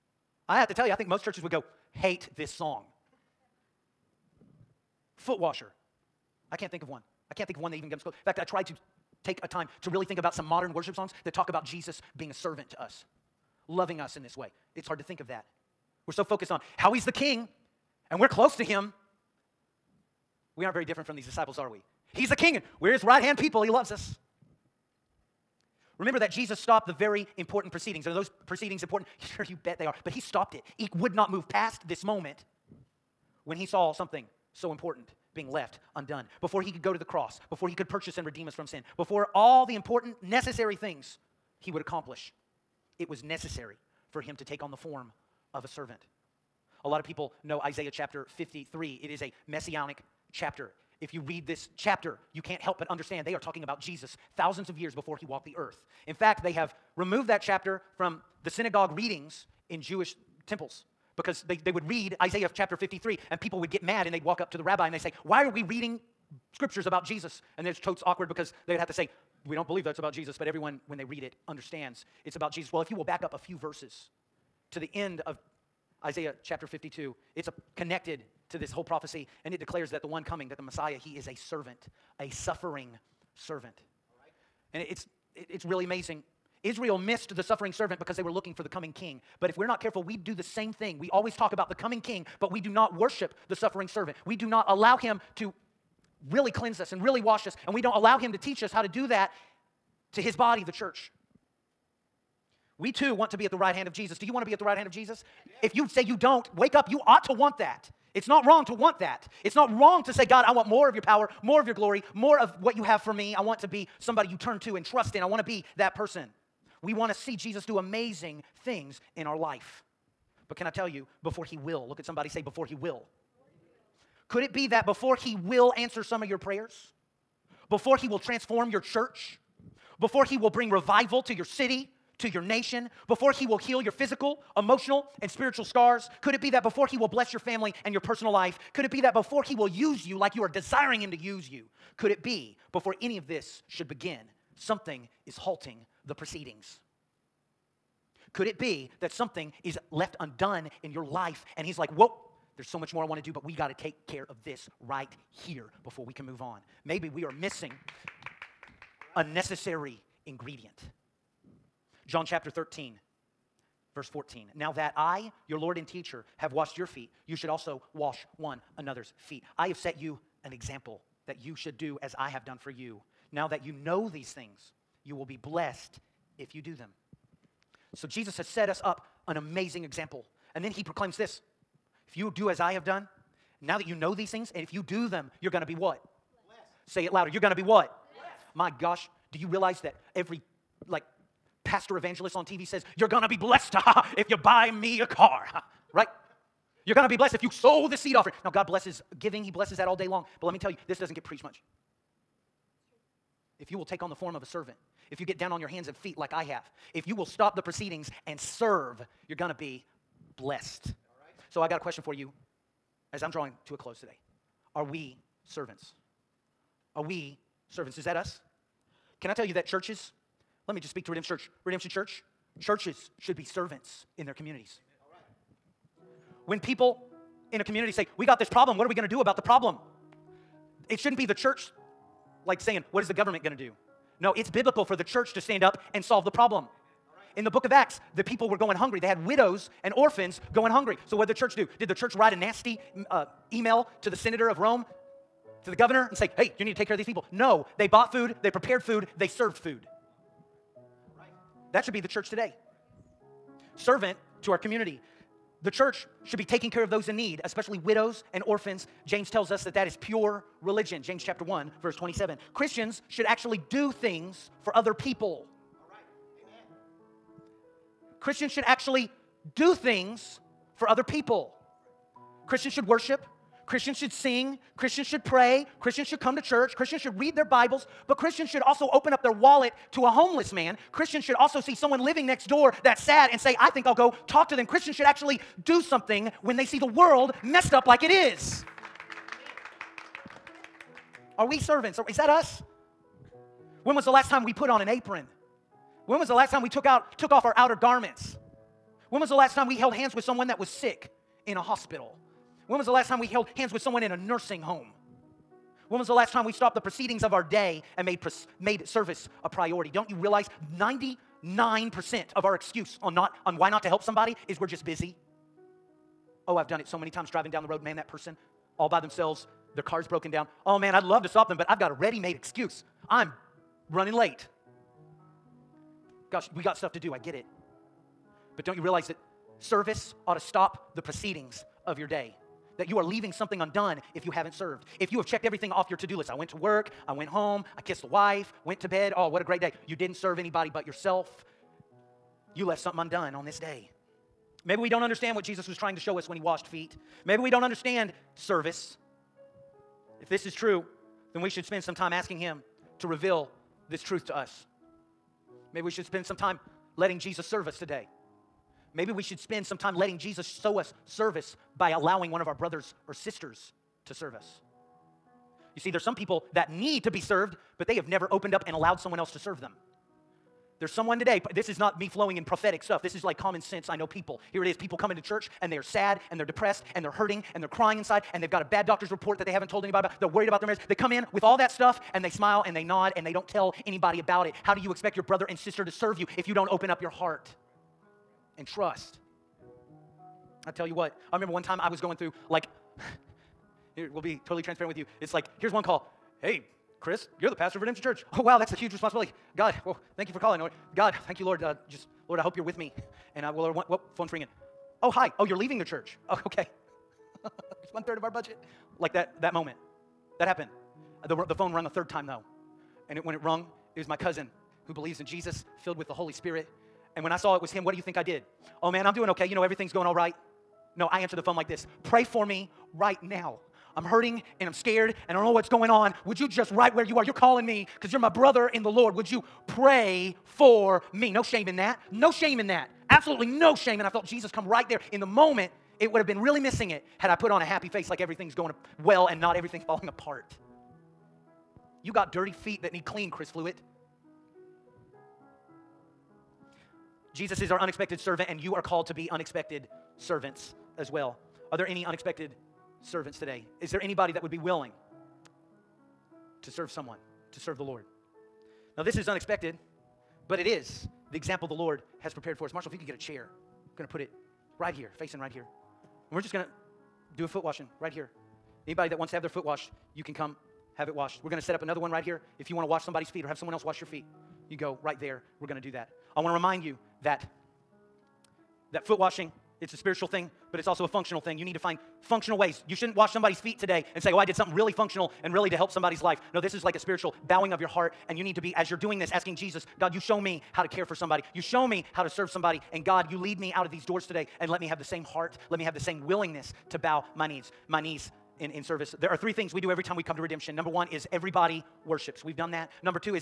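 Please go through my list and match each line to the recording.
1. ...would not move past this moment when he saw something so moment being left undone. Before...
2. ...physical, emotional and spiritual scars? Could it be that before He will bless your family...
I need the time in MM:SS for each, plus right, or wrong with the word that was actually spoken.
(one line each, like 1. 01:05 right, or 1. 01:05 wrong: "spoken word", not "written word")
1. 00:30 wrong: "important", not "moment"
2. 02:13 right.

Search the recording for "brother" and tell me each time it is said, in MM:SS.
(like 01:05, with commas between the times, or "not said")
06:02, 06:25, 07:08.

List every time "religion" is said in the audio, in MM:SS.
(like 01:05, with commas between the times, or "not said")
04:20.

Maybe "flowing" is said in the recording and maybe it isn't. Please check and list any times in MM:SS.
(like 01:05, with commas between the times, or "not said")
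06:12.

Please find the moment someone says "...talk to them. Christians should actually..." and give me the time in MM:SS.
04:44.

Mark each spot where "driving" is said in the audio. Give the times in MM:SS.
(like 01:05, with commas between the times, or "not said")
05:17.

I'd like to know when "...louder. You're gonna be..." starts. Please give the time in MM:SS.
03:07.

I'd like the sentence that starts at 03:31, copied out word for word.
So I got a question for you as I'm drawing to a close today.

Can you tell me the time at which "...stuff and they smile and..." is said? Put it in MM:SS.
06:21.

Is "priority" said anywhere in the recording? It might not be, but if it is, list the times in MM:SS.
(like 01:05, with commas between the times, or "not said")
05:09.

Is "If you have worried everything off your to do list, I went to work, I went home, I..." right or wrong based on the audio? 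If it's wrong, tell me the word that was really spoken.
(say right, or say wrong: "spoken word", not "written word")
wrong: "checked", not "worried".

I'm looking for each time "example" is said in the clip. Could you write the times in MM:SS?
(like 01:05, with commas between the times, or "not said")
02:50, 02:59, 07:41.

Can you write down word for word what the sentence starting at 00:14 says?
It's hard to think of that.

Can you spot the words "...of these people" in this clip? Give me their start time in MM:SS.
04:06.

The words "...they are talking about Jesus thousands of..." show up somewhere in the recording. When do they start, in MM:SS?
00:53.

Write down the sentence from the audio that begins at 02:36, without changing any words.
Maybe we are missing a necessary ingredient.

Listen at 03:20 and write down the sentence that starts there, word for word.
But let me tell you, this doesn't get preached much.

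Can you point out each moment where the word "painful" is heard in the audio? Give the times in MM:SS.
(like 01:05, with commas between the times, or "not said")
not said.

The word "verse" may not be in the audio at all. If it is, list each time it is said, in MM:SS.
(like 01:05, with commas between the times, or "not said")
01:13, 02:43, 04:21.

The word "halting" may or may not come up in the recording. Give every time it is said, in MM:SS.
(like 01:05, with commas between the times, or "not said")
02:25.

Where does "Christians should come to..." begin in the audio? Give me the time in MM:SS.
04:35.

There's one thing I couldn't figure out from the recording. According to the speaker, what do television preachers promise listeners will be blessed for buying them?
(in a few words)
A car.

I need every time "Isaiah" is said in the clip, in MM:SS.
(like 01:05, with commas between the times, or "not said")
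00:47, 01:02, 01:16.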